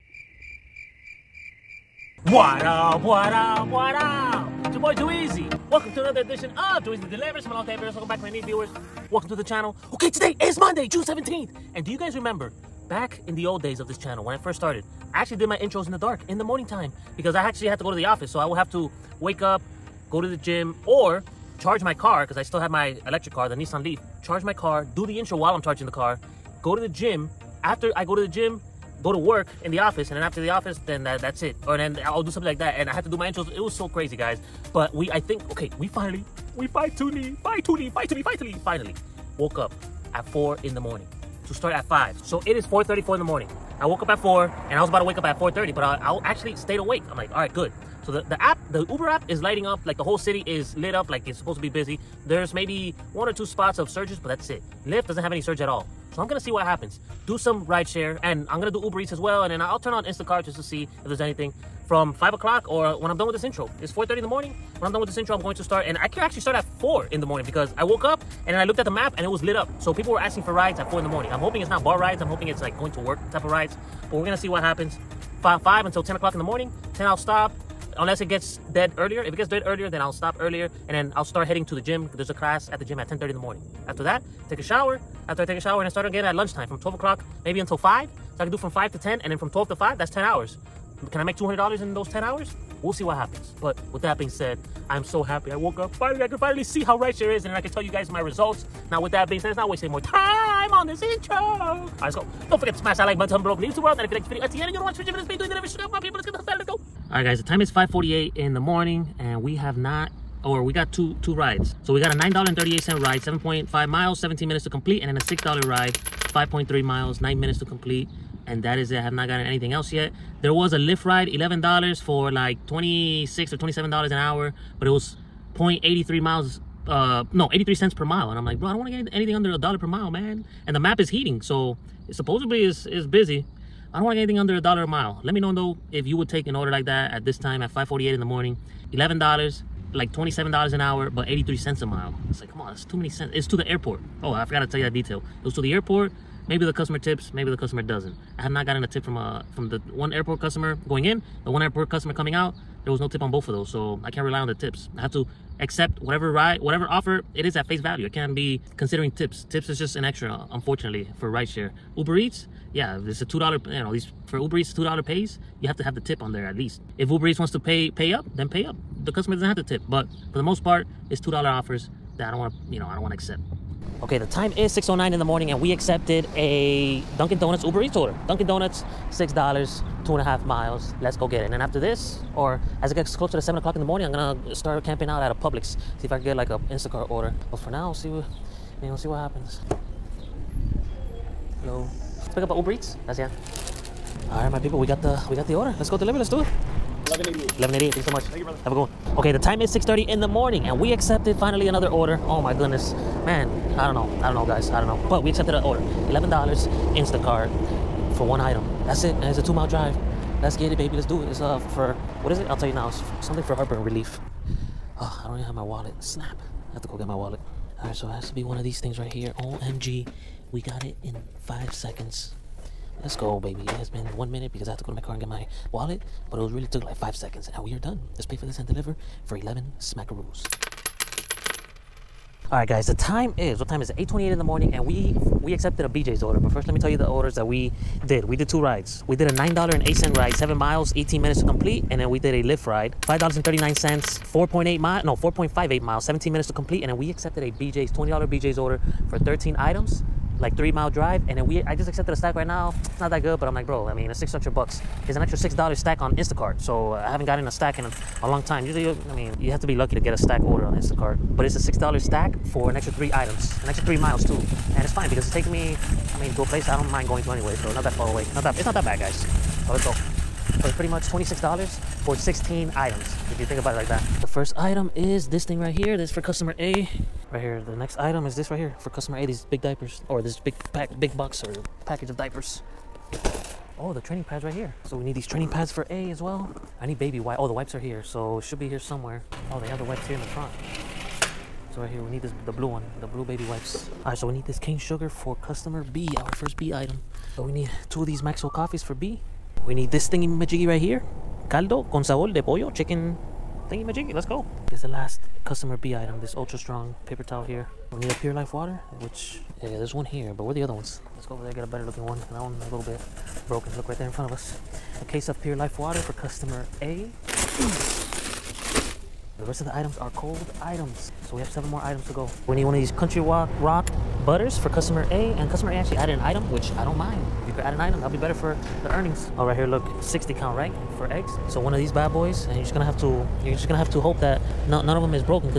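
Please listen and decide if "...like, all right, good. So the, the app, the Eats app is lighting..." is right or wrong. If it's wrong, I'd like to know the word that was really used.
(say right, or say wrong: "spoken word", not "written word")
wrong: "Uber", not "Eats".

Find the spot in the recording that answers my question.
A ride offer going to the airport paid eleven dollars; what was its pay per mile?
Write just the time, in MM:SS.
02:07.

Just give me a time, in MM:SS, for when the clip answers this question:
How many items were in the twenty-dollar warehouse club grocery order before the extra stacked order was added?
04:09.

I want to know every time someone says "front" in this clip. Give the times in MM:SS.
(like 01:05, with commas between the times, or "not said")
04:50, 05:14.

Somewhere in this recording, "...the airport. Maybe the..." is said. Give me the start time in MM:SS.
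02:25.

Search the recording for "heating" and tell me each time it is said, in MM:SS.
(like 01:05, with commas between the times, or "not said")
02:11.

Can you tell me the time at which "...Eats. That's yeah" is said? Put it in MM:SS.
03:12.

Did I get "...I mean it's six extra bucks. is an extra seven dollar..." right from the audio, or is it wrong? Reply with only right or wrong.
wrong.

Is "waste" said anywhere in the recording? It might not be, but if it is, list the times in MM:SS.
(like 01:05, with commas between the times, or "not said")
01:39.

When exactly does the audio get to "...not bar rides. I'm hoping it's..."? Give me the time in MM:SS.
01:11.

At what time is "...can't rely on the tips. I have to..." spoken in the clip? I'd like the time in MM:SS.
02:34.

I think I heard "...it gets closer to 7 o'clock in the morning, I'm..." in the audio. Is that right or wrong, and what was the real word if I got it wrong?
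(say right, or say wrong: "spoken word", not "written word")
right.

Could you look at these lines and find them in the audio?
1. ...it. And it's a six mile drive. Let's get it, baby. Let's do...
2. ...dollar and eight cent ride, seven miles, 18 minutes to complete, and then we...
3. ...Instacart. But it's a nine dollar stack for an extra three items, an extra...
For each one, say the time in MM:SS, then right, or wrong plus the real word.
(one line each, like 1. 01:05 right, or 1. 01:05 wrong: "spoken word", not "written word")
1. 03:29 wrong: "two", not "six"
2. 03:59 right
3. 04:20 wrong: "six", not "nine".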